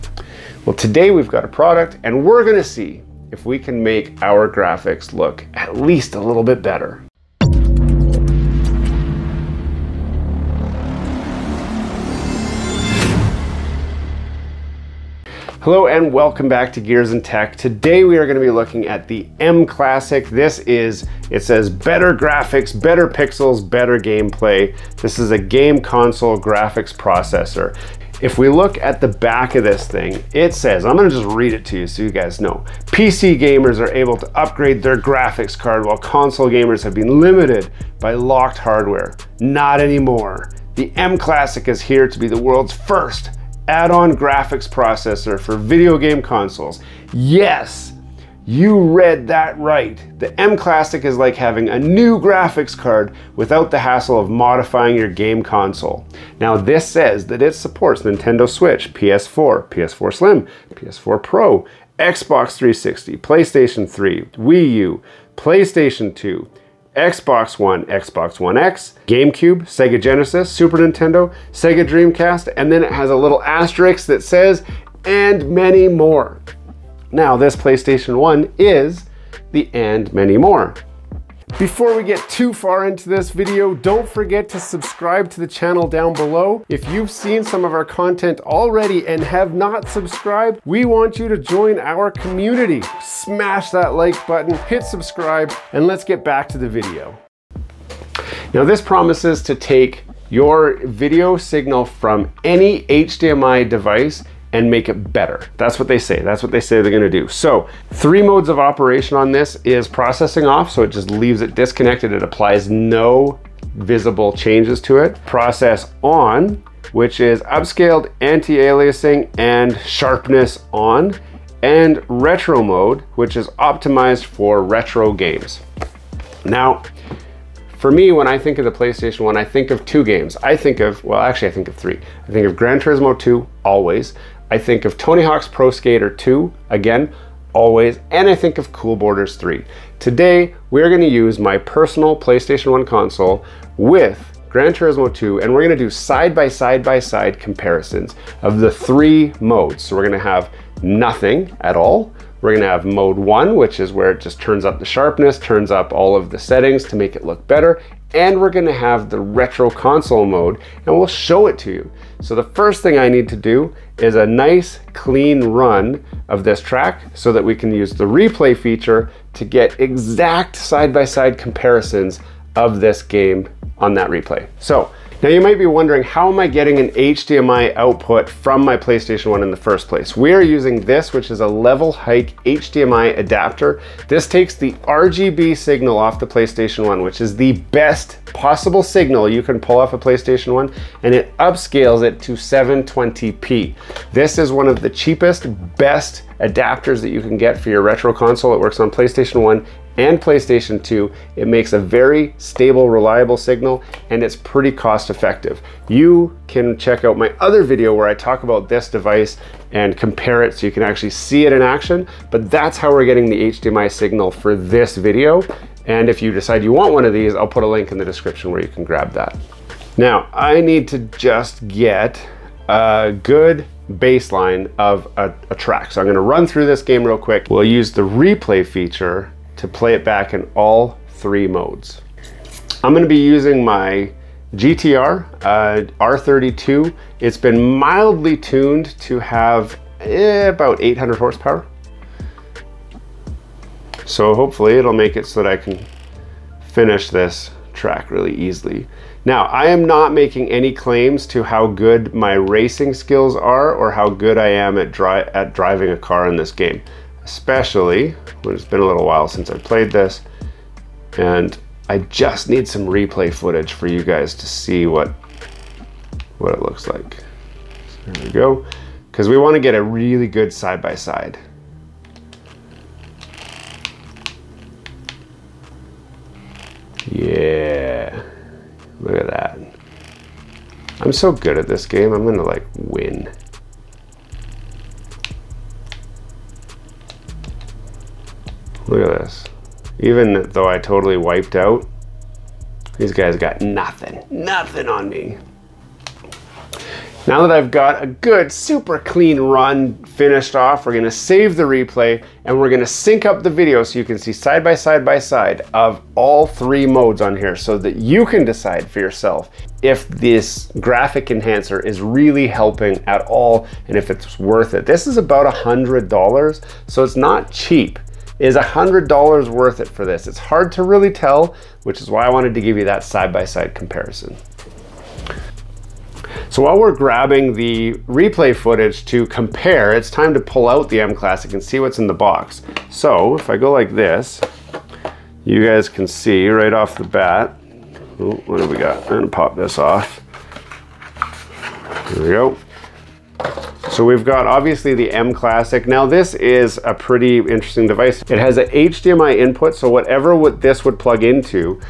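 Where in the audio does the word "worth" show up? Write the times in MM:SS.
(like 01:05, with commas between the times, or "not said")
05:14, 05:19.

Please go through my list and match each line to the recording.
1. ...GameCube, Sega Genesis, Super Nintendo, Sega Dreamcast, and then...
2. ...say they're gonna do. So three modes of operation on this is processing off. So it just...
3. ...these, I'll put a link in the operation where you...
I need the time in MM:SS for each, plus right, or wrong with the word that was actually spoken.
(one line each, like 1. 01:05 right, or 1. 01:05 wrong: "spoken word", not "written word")
1. 01:09 right
2. 01:46 right
3. 03:37 wrong: "description", not "operation".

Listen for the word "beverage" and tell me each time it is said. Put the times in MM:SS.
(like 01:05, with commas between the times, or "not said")
not said.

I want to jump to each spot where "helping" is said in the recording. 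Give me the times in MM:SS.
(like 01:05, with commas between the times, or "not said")
05:12.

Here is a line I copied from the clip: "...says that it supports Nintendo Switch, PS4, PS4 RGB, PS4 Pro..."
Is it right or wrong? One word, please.
wrong.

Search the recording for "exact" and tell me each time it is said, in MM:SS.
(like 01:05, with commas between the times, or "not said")
02:49.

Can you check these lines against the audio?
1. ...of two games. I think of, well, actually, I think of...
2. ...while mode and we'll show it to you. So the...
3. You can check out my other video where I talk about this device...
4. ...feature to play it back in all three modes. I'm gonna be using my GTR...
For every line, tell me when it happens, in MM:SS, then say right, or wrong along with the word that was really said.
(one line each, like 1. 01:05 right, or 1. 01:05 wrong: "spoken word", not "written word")
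1. 02:09 right
2. 02:39 wrong: "console", not "while"
3. 03:25 right
4. 03:48 right.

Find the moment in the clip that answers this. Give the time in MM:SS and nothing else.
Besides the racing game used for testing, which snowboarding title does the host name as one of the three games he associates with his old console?
02:18.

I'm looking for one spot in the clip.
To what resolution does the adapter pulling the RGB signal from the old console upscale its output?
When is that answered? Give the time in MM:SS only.
03:12.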